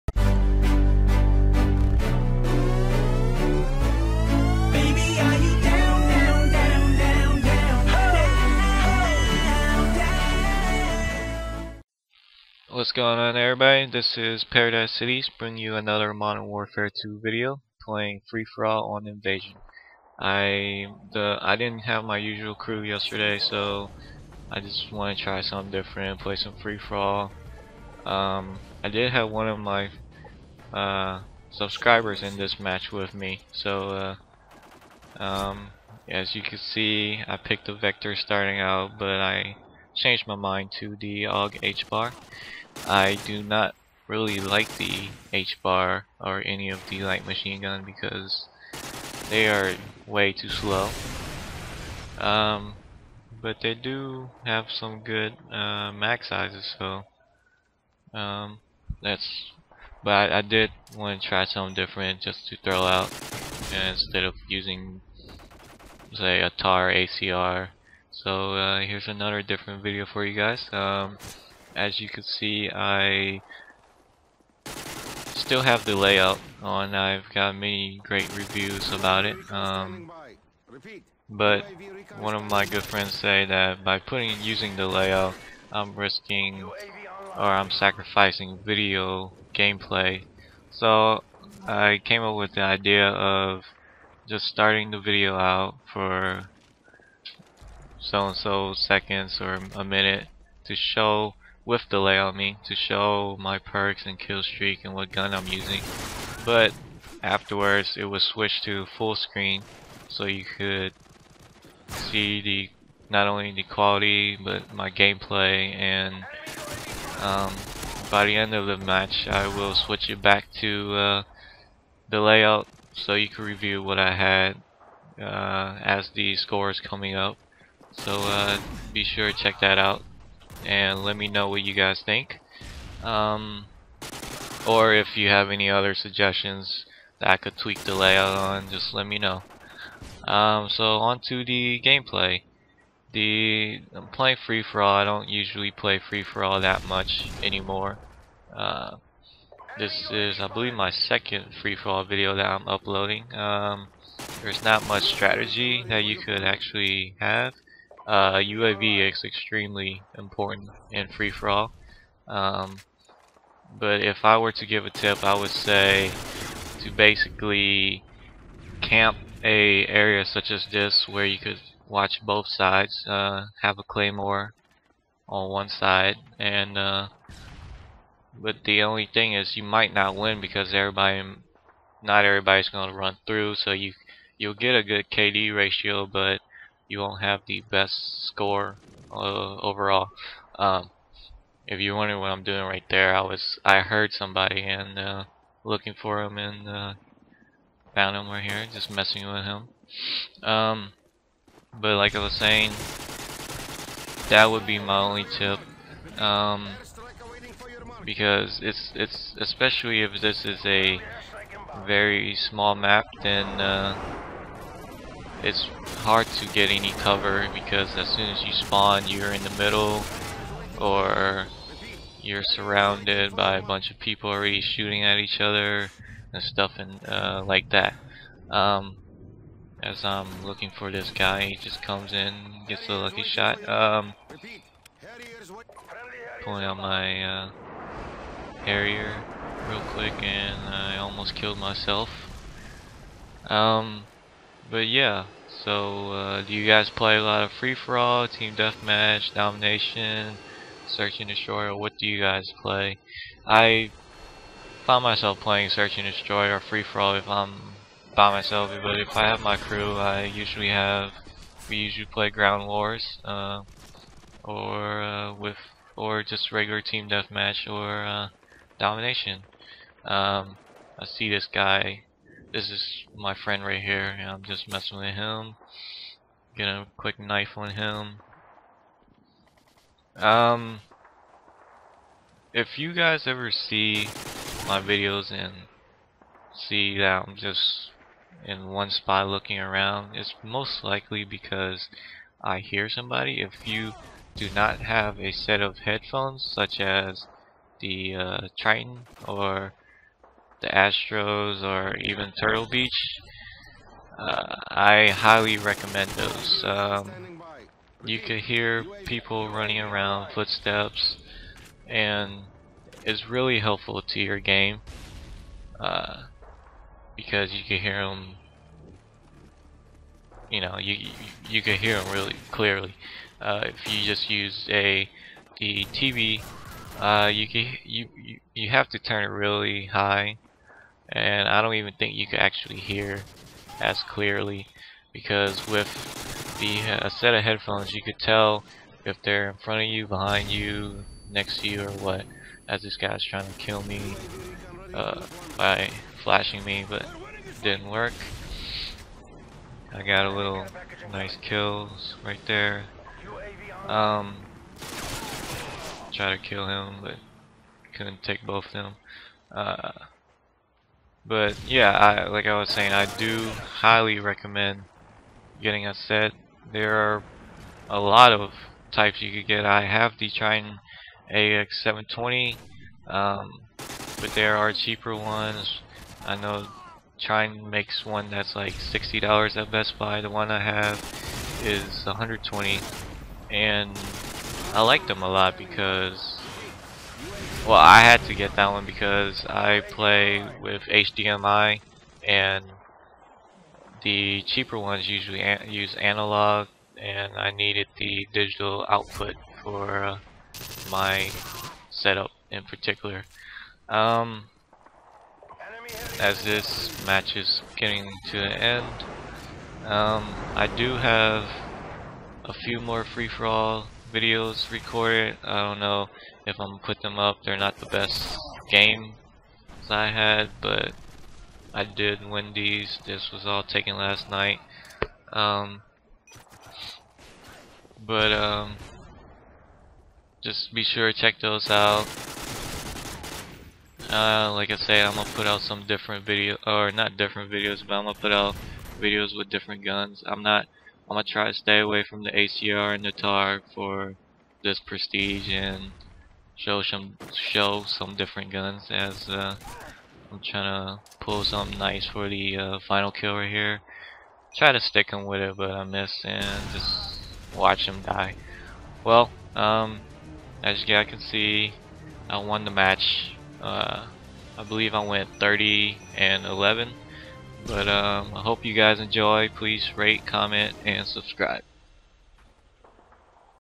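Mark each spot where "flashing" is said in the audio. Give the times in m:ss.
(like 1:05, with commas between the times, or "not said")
5:46.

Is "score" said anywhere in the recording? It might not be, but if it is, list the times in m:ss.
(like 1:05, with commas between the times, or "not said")
2:06, 3:08.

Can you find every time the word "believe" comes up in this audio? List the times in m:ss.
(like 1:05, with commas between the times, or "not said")
2:30, 7:44.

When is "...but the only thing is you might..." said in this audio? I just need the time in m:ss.
2:58.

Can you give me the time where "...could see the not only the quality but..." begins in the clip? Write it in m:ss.
1:50.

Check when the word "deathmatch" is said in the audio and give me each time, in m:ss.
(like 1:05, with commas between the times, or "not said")
4:08, 4:27.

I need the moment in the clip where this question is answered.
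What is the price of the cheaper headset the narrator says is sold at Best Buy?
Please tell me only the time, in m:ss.
6:18.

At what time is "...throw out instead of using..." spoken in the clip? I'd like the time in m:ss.
1:02.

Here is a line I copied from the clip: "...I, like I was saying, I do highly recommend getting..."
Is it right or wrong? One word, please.
right.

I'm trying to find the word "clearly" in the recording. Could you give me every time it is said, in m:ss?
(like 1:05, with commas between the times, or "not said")
5:22, 5:34.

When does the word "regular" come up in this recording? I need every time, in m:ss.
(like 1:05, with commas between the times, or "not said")
4:26.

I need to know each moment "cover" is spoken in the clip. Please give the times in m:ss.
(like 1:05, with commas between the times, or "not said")
3:36.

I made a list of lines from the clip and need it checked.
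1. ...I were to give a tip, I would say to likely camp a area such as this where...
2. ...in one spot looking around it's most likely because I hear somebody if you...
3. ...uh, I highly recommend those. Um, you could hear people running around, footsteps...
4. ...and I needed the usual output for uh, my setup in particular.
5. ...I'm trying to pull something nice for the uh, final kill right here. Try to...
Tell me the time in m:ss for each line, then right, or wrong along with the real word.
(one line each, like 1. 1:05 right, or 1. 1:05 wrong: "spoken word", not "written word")
1. 2:44 wrong: "basically", not "likely"
2. 4:48 right
3. 5:04 right
4. 6:36 wrong: "digital", not "usual"
5. 7:30 right.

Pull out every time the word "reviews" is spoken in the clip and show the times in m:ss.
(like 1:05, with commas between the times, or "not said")
1:18, 2:03.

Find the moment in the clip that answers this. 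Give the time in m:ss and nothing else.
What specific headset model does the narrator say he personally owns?
6:10.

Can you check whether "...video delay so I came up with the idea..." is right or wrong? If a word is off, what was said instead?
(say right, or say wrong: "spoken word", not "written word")
wrong: "gameplay", not "delay".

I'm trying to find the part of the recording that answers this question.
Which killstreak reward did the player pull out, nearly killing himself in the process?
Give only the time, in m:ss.
3:58.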